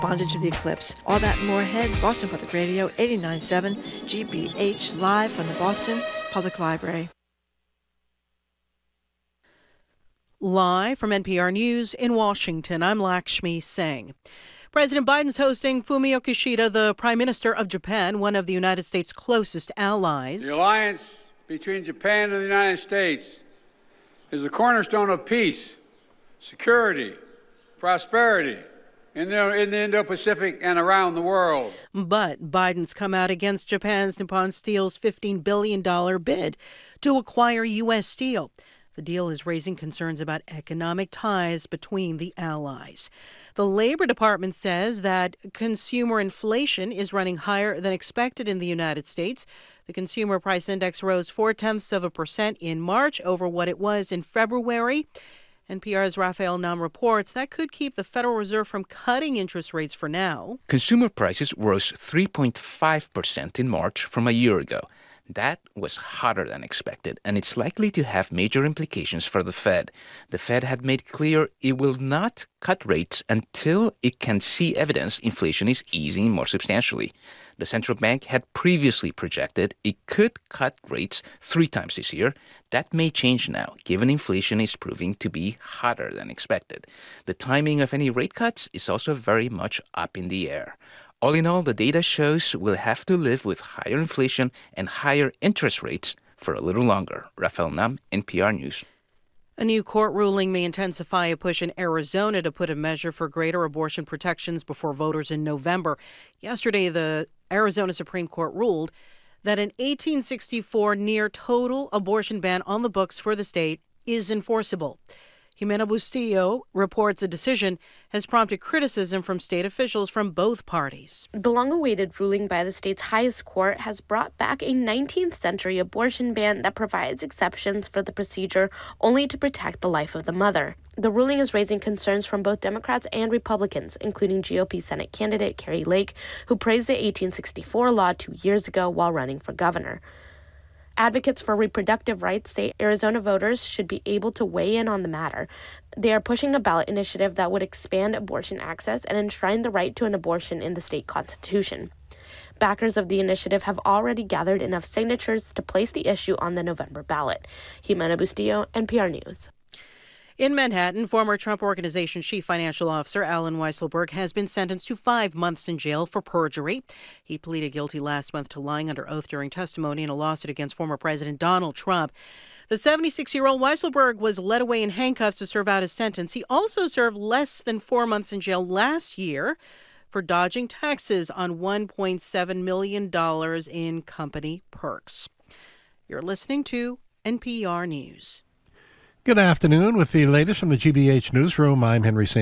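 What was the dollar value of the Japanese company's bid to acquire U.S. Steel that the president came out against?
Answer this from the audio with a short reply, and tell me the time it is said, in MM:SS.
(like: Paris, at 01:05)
$15 billion, at 00:34.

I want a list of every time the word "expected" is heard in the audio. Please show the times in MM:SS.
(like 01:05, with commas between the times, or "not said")
00:47, 01:06, 01:26.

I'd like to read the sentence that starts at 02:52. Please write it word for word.
The 76 year old Weisselberg was led away in handcuffs to serve out his sentence.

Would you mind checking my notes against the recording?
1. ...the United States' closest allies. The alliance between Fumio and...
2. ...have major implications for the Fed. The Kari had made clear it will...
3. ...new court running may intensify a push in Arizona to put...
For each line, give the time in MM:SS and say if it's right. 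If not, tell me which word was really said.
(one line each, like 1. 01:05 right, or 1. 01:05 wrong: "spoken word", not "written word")
1. 00:18 wrong: "Japan", not "Fumio"
2. 01:08 wrong: "Fed", not "Kari"
3. 01:39 wrong: "ruling", not "running".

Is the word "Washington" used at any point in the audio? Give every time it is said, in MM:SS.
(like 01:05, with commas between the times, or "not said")
00:12.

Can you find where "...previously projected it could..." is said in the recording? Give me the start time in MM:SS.
01:18.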